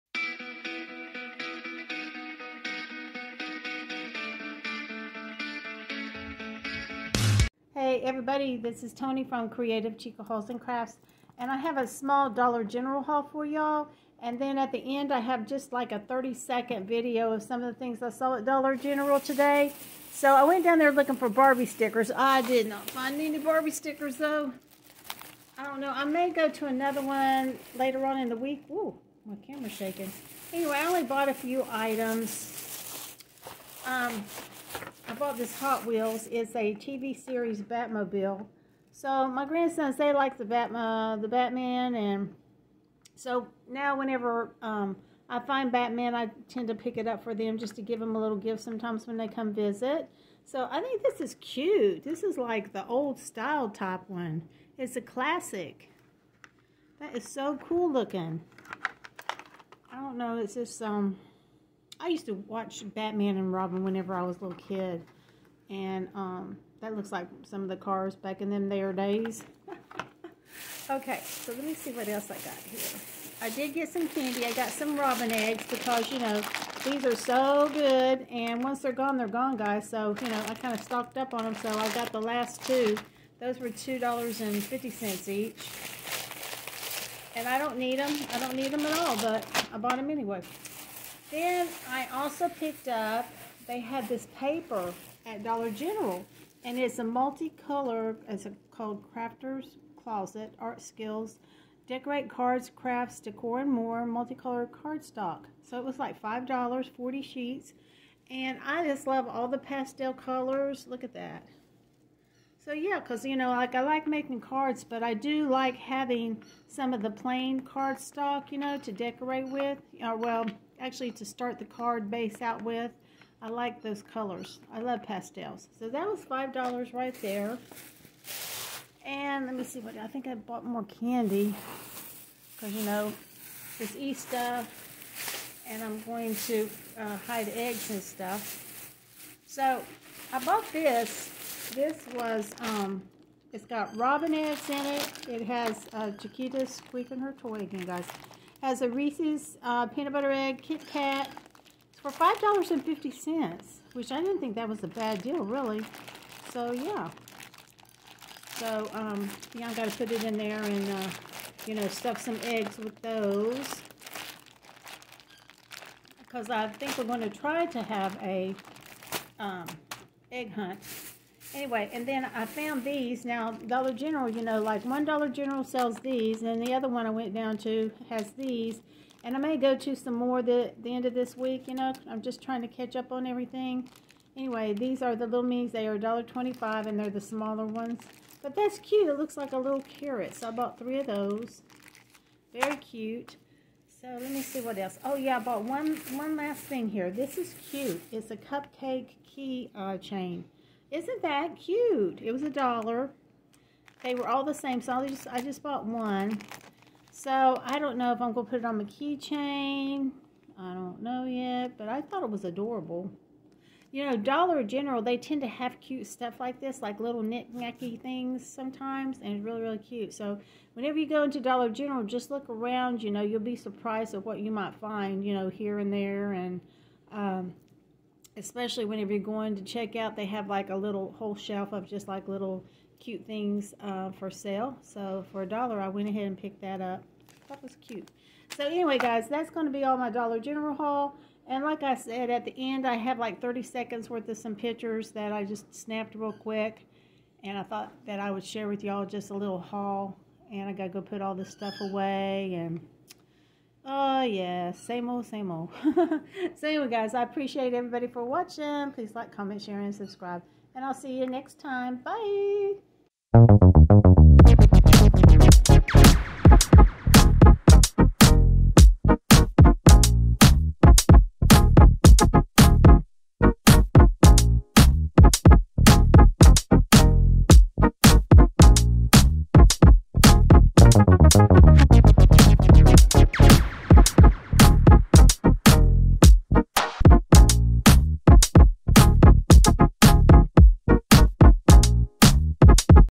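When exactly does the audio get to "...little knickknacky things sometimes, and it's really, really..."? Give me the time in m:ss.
3:36.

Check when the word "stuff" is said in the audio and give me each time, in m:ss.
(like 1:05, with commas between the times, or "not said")
2:18, 2:41, 3:36, 4:11.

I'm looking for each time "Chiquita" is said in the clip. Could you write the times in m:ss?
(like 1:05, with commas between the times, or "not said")
2:26.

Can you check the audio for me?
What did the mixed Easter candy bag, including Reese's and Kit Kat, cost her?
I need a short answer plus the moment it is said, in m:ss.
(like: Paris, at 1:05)
$5.50, at 2:32.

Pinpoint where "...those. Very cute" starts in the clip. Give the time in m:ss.
3:11.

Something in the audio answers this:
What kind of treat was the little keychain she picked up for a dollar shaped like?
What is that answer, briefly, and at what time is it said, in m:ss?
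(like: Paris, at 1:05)
Cupcake, at 3:18.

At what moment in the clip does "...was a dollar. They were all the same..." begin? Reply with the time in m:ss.
3:22.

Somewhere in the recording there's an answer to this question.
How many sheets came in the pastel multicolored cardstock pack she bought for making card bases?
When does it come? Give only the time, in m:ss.
1:46.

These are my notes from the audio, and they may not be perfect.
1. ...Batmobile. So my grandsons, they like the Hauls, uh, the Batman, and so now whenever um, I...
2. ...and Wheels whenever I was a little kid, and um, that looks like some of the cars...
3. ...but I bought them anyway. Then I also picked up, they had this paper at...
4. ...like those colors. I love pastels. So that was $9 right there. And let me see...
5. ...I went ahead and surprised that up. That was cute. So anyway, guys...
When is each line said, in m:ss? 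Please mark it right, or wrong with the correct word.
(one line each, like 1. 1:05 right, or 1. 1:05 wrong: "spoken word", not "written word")
1. 0:37 wrong: "Batman", not "Hauls"
2. 1:03 wrong: "Robin", not "Wheels"
3. 1:29 right
4. 2:03 wrong: "5", not "9"
5. 3:55 wrong: "picked", not "surprised".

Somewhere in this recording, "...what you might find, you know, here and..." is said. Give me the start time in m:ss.
3:44.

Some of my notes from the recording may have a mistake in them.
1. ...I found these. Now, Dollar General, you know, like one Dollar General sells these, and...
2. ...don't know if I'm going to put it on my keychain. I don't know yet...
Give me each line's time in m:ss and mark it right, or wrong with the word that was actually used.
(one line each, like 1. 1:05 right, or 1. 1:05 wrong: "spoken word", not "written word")
1. 2:52 right
2. 3:27 right.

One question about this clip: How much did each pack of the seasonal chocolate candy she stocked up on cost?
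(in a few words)
$2.50.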